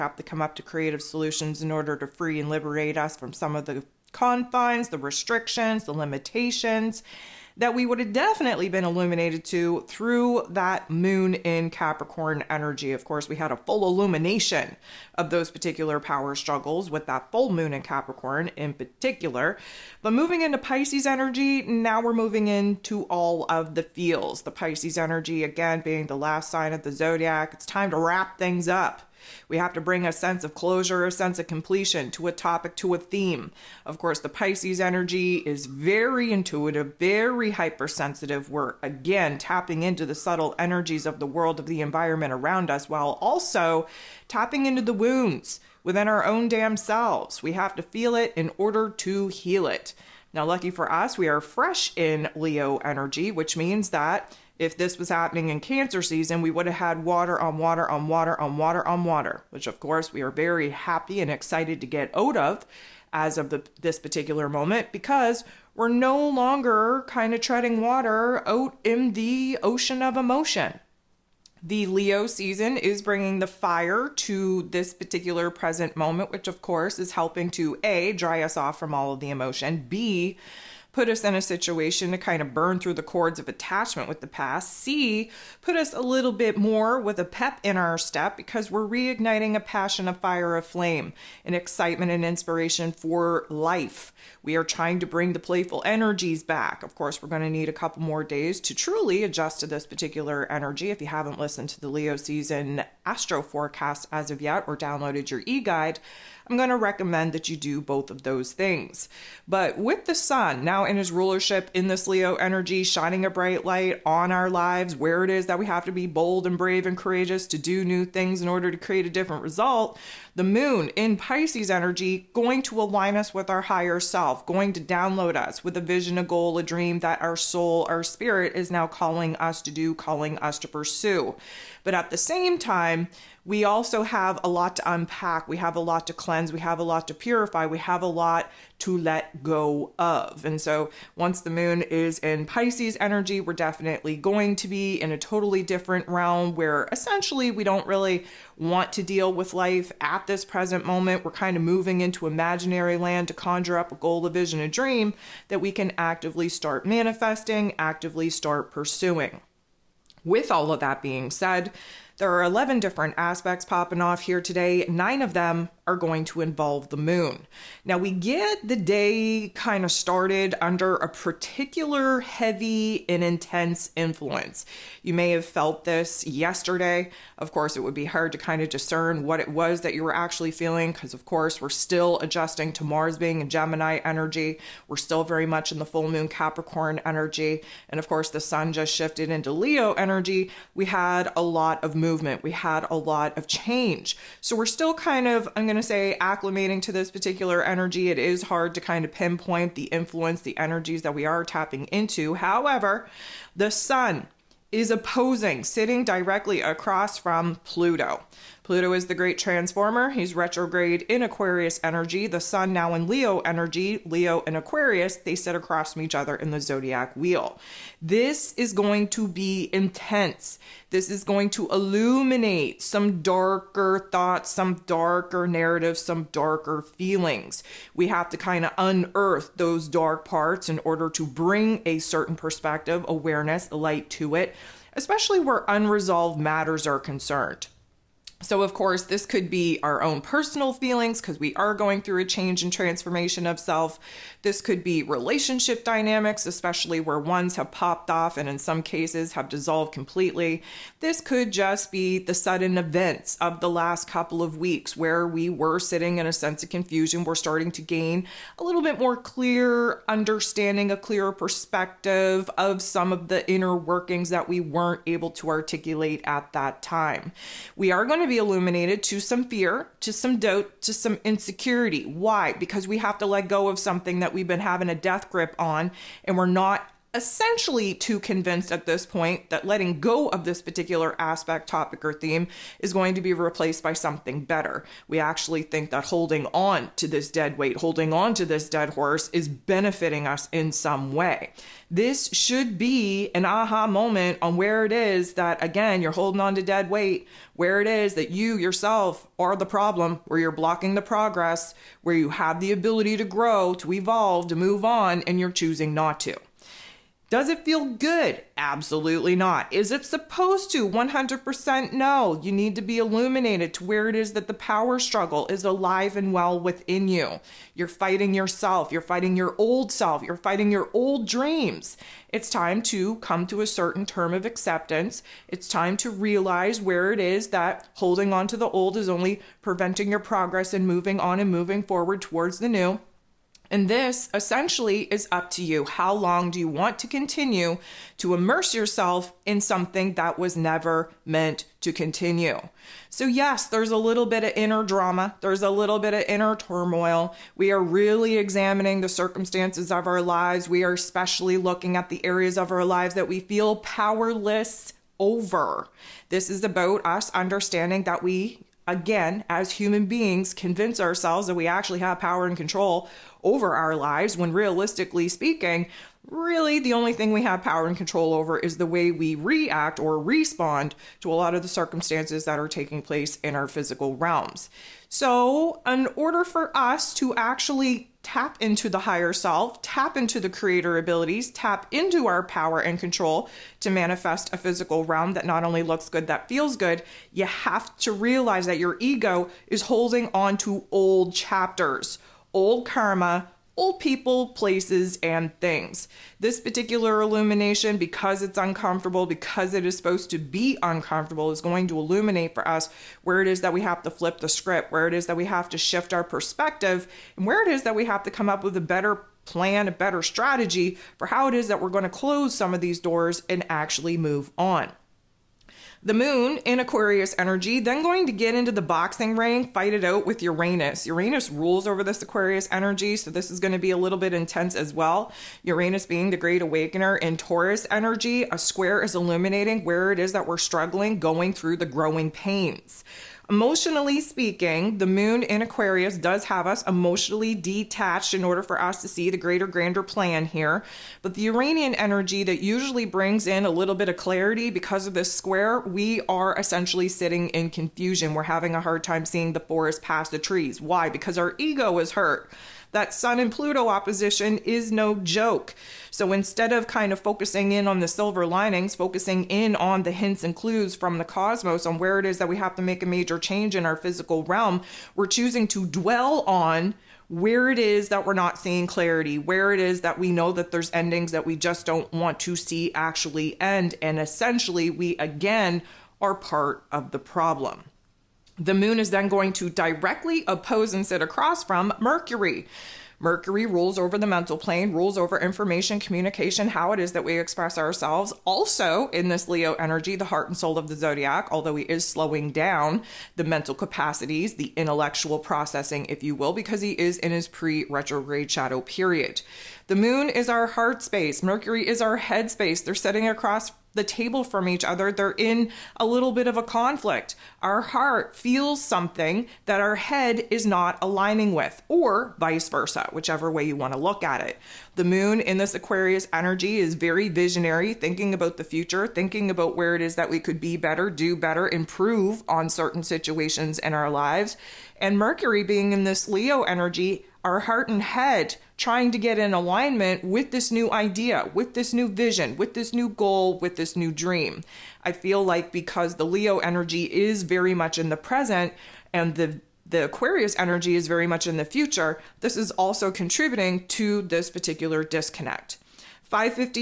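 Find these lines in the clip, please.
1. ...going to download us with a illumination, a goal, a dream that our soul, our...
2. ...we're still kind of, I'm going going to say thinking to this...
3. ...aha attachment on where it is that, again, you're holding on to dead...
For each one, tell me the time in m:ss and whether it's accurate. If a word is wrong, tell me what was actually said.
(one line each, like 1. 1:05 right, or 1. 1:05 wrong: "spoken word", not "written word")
1. 2:04 wrong: "vision", not "illumination"
2. 3:14 wrong: "acclimating", not "thinking"
3. 4:53 wrong: "moment", not "attachment".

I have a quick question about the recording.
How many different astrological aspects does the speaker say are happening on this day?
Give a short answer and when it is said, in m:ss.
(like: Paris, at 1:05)
11, at 2:42.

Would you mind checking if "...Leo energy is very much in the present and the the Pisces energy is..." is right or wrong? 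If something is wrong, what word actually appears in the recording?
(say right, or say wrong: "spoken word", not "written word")
wrong: "Aquarius", not "Pisces".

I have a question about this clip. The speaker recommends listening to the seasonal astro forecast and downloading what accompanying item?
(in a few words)
E guide.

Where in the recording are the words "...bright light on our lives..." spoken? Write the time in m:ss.
1:53.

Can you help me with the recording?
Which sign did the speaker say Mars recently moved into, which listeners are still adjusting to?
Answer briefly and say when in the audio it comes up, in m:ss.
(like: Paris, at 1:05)
Gemini, at 3:03.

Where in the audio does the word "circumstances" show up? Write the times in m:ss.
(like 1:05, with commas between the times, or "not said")
5:49, 6:11.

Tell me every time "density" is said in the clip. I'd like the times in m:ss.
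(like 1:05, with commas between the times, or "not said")
not said.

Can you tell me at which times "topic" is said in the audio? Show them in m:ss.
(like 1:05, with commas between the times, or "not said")
0:32, 4:41.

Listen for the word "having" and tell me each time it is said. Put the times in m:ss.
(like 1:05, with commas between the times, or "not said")
4:34, 7:28.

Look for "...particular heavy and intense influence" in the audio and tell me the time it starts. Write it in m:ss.
2:51.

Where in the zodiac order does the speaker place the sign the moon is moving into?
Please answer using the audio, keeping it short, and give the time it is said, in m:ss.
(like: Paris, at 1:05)
Last sign, at 0:26.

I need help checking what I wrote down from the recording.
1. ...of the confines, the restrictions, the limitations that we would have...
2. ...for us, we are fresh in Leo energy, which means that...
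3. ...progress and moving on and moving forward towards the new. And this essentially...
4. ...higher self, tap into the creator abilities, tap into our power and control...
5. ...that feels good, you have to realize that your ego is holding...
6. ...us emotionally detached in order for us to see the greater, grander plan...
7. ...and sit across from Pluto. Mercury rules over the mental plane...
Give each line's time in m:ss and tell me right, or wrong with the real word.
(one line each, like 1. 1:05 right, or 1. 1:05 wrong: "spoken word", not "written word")
1. 0:03 right
2. 0:50 right
3. 5:30 right
4. 6:18 right
5. 6:26 right
6. 7:16 right
7. 8:00 wrong: "Mercury", not "Pluto".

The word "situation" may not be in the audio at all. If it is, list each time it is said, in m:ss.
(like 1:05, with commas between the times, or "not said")
1:21, 8:43.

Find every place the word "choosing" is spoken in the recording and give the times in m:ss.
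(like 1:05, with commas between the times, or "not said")
5:05, 7:45.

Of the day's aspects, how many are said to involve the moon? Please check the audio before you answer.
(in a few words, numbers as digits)
9.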